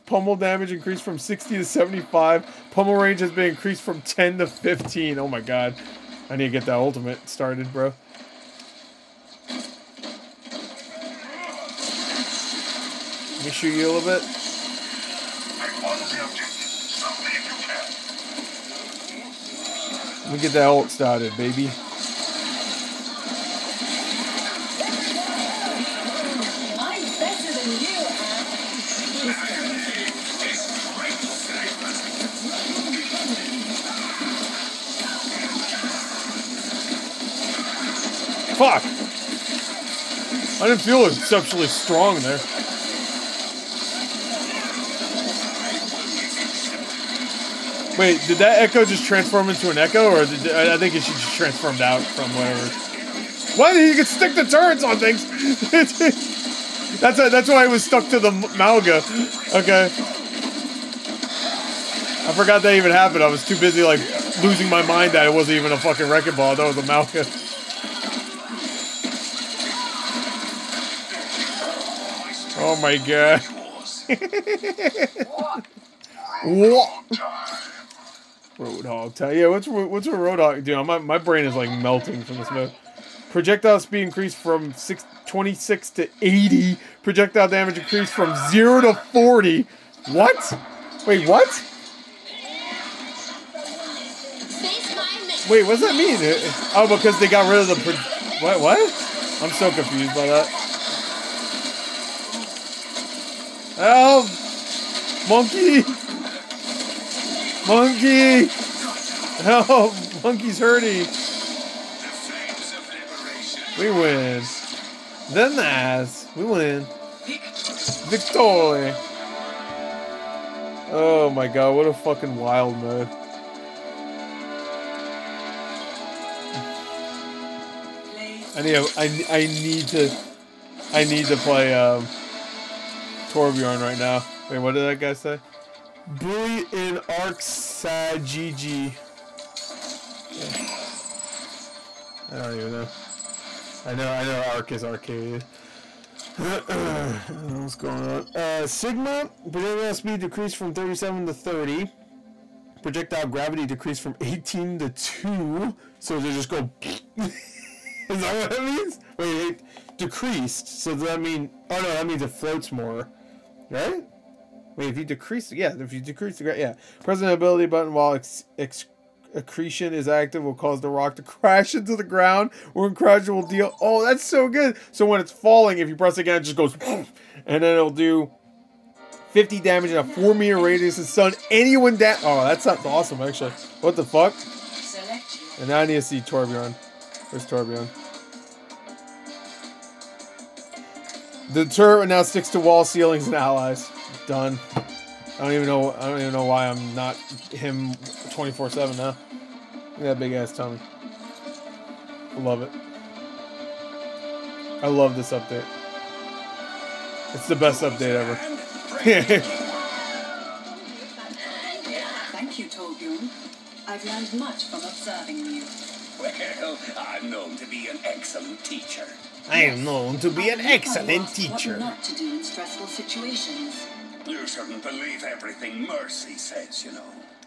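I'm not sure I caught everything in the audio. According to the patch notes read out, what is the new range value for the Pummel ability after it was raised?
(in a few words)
15.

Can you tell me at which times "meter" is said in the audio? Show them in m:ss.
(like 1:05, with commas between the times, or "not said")
3:00.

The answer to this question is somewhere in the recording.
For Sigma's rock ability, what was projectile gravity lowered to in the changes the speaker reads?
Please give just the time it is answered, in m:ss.
2:34.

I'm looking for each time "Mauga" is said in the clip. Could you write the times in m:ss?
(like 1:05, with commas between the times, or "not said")
0:58, 1:06.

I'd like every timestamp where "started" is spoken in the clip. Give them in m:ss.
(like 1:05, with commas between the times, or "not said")
0:07, 0:20.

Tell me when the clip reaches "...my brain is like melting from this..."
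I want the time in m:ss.
1:20.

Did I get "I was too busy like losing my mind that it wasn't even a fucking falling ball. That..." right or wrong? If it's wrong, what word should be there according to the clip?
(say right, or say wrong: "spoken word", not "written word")
wrong: "wrecking", not "falling".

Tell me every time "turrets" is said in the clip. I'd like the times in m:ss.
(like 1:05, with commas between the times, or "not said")
0:54, 3:11.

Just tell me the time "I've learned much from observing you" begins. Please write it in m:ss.
3:33.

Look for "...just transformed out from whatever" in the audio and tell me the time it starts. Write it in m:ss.
0:51.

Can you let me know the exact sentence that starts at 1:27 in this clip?
Projectile damage increased from 0 to 40.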